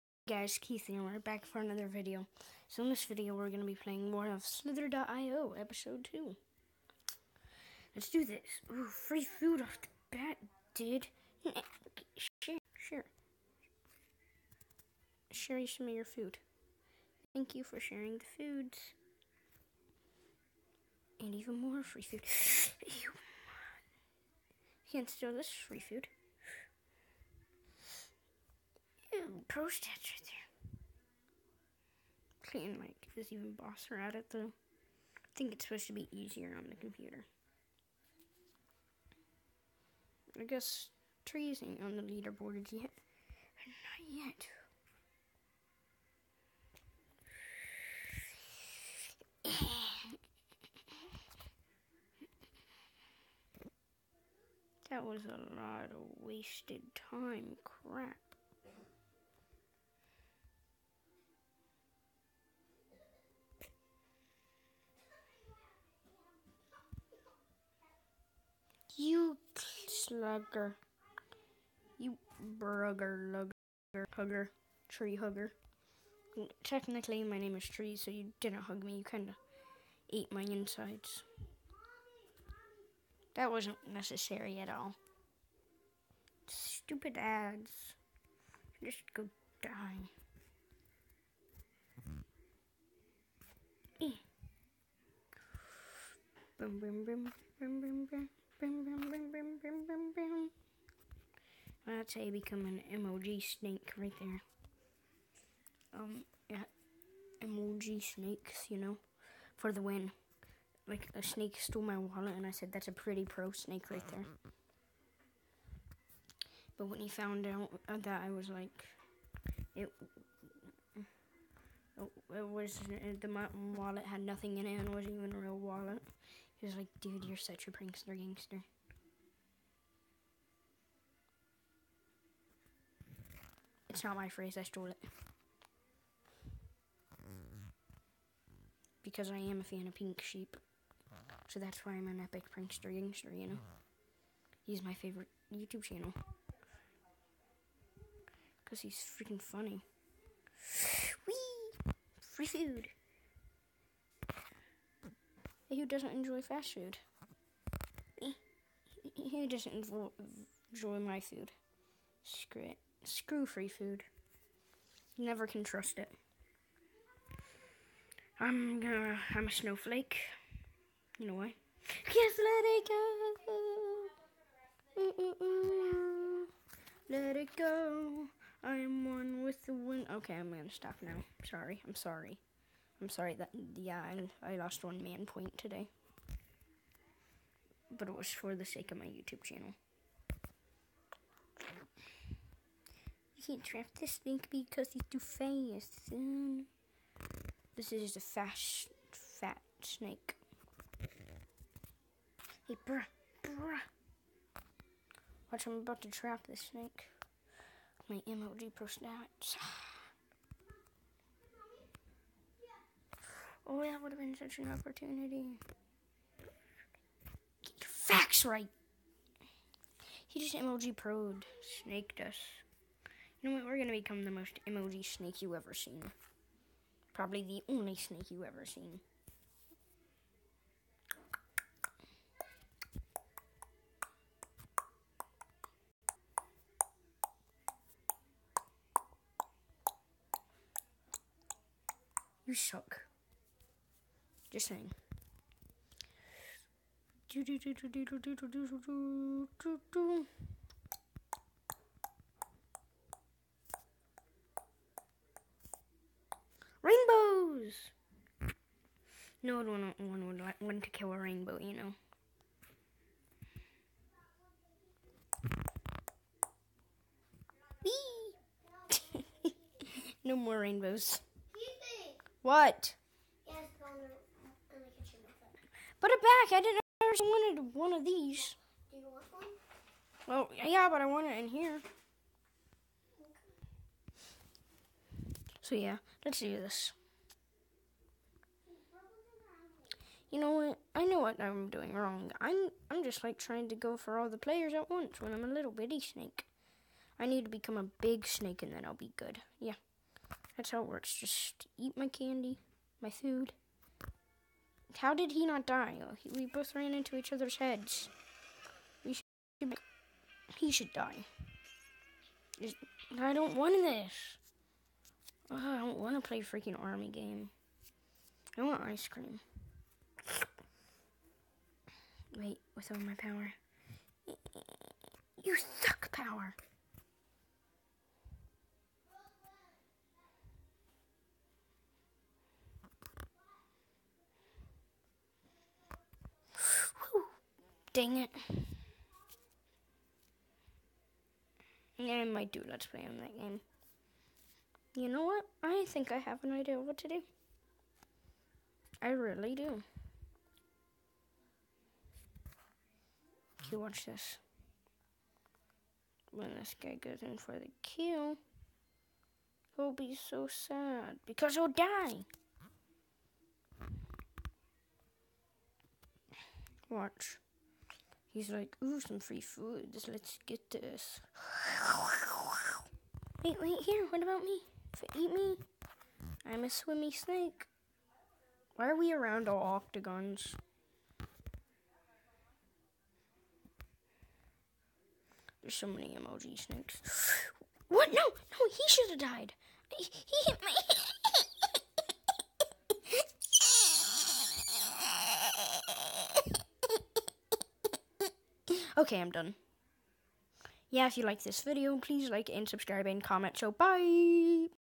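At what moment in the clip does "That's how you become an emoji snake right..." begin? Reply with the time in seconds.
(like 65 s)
101 s.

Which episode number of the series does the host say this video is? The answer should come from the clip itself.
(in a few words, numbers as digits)
2.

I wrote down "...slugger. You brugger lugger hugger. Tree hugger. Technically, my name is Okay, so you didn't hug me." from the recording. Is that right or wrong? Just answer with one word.
wrong.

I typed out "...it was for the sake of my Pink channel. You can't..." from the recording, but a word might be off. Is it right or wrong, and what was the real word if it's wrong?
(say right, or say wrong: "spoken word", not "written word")
wrong: "YouTube", not "Pink".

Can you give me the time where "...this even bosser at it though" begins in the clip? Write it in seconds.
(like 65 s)
33 s.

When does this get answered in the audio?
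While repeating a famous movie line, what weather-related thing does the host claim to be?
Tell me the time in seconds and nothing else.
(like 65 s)
169 s.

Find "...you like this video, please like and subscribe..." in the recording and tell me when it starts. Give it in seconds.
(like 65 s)
401 s.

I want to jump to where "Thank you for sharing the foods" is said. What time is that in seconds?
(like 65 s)
17 s.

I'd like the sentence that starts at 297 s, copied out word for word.
I need to become a big snake and then I'll be good.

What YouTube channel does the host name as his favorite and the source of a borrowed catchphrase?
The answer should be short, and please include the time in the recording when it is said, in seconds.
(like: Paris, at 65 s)
Pink Sheep, at 139 s.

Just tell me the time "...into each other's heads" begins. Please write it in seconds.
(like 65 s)
306 s.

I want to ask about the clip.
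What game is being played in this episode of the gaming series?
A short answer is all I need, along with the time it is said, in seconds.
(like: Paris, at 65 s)
Slither.io, at 4 s.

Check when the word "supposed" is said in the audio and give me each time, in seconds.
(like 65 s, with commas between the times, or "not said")
35 s.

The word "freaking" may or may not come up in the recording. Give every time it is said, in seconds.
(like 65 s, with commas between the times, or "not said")
149 s, 316 s.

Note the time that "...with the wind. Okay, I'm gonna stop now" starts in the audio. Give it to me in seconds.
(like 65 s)
179 s.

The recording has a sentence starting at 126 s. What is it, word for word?
He was like, dude, you're such a prankster gangster.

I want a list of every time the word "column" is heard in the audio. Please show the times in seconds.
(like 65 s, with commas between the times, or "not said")
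not said.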